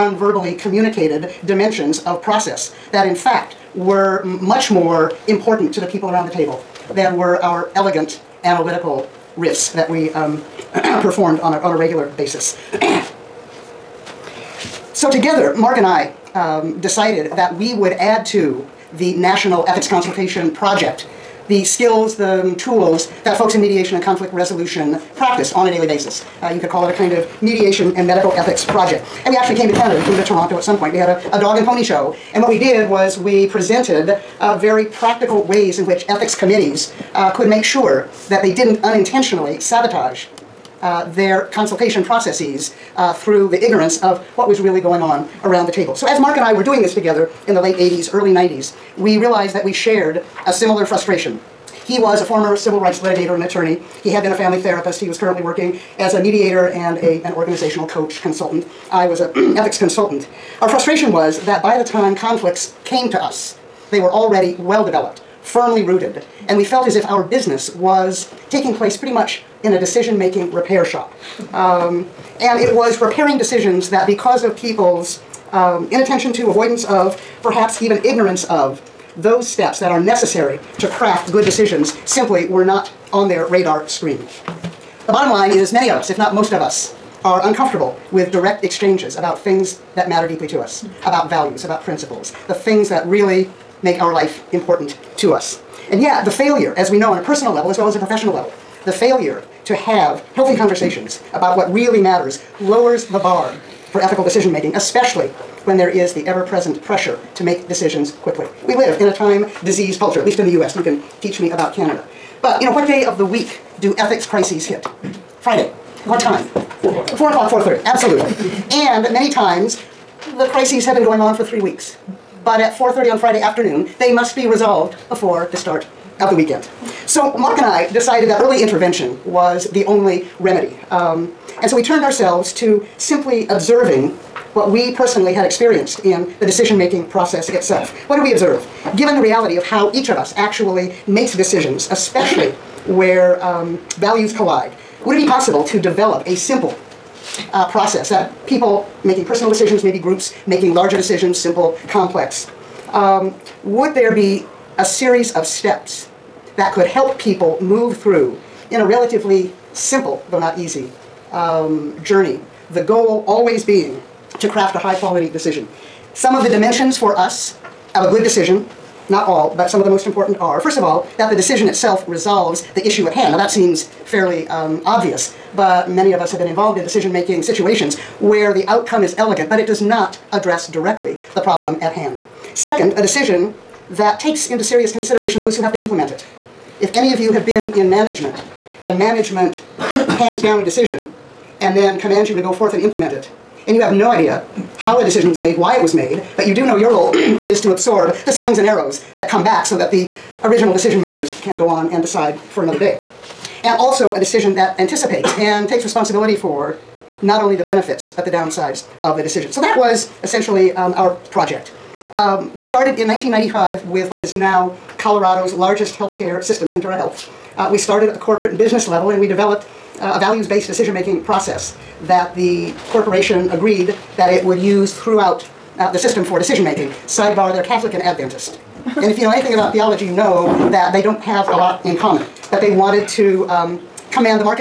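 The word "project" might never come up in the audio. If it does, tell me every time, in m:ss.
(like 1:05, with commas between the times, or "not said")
0:20, 0:28, 3:31.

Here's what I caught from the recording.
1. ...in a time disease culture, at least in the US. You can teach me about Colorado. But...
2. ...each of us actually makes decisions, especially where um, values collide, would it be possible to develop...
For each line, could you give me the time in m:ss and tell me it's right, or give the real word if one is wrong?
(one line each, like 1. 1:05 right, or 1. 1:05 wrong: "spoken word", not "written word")
1. 1:48 wrong: "Canada", not "Colorado"
2. 2:19 right.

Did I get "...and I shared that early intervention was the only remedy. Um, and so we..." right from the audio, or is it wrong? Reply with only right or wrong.
wrong.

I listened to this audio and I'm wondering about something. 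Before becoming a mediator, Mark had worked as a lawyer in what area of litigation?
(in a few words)
Civil rights.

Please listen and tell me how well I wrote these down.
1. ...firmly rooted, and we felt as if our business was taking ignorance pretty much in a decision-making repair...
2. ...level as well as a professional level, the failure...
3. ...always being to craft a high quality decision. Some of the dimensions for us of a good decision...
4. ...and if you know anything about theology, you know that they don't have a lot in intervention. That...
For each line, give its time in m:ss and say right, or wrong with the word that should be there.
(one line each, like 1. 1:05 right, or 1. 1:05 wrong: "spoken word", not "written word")
1. 1:05 wrong: "place", not "ignorance"
2. 1:37 right
3. 2:43 right
4. 3:48 wrong: "common", not "intervention".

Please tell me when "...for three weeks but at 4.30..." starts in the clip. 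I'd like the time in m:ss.
2:01.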